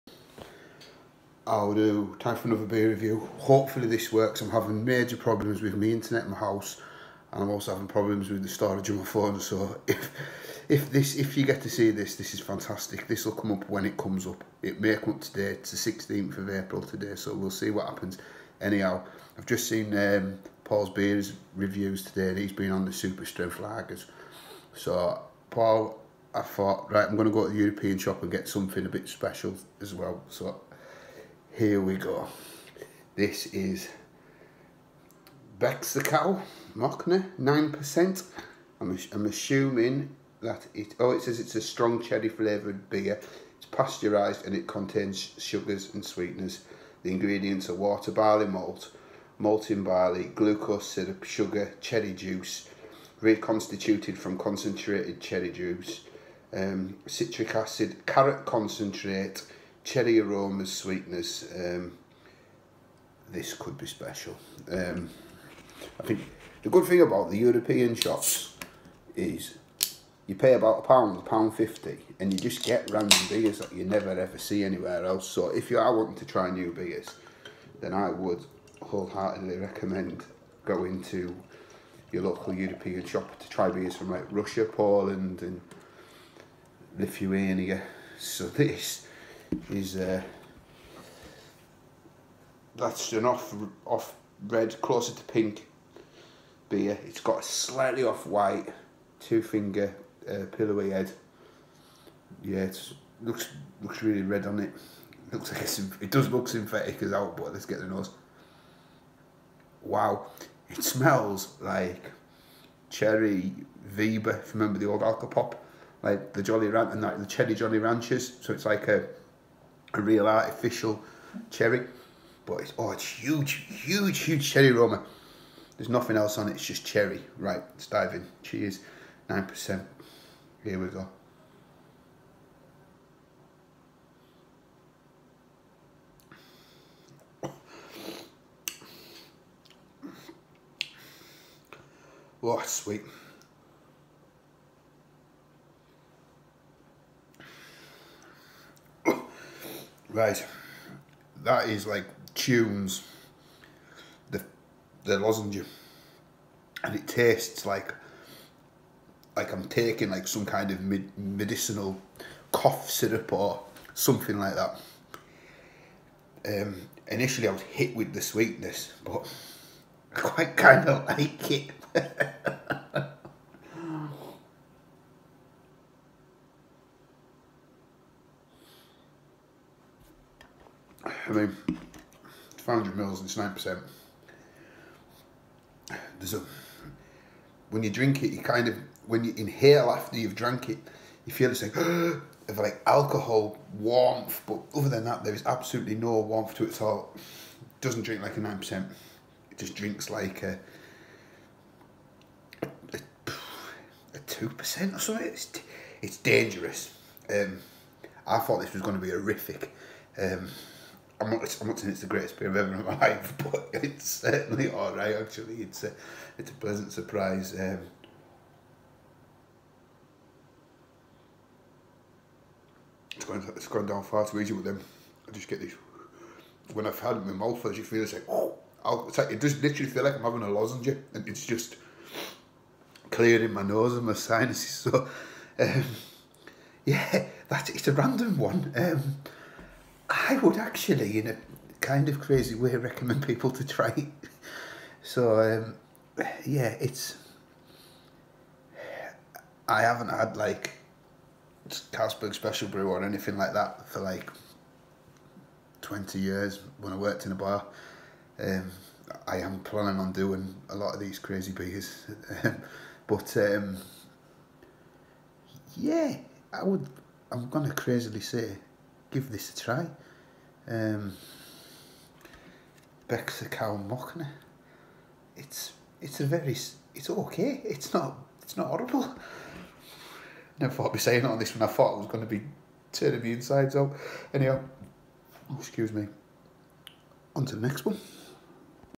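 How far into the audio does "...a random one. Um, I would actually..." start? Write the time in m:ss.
3:57.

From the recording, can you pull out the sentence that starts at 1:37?
It's got a slightly off white, two finger uh, pillowy head.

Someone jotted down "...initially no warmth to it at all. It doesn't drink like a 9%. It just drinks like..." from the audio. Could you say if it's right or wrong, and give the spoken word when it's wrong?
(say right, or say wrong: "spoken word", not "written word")
wrong: "absolutely", not "initially".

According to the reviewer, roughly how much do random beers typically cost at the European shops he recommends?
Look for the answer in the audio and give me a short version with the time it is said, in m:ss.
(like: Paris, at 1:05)
a pound fifty, at 1:11.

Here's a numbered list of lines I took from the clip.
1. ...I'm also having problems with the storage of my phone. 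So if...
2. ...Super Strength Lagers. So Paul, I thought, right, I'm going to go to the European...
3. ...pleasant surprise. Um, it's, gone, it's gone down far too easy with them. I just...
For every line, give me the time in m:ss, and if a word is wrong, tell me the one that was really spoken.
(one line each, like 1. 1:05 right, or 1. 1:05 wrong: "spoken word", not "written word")
1. 0:07 right
2. 0:22 right
3. 3:36 right.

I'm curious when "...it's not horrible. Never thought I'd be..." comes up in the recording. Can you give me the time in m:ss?
4:38.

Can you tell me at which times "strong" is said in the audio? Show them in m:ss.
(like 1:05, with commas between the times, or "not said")
0:41.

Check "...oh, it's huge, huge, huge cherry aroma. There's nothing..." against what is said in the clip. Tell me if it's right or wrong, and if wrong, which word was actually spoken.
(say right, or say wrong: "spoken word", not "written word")
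right.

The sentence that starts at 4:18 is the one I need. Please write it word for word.
Um, I am planning on doing a lot of these crazy beers.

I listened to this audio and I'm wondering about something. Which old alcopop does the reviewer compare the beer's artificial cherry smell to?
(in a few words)
Cherry Viva.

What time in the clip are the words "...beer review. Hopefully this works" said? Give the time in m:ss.
0:02.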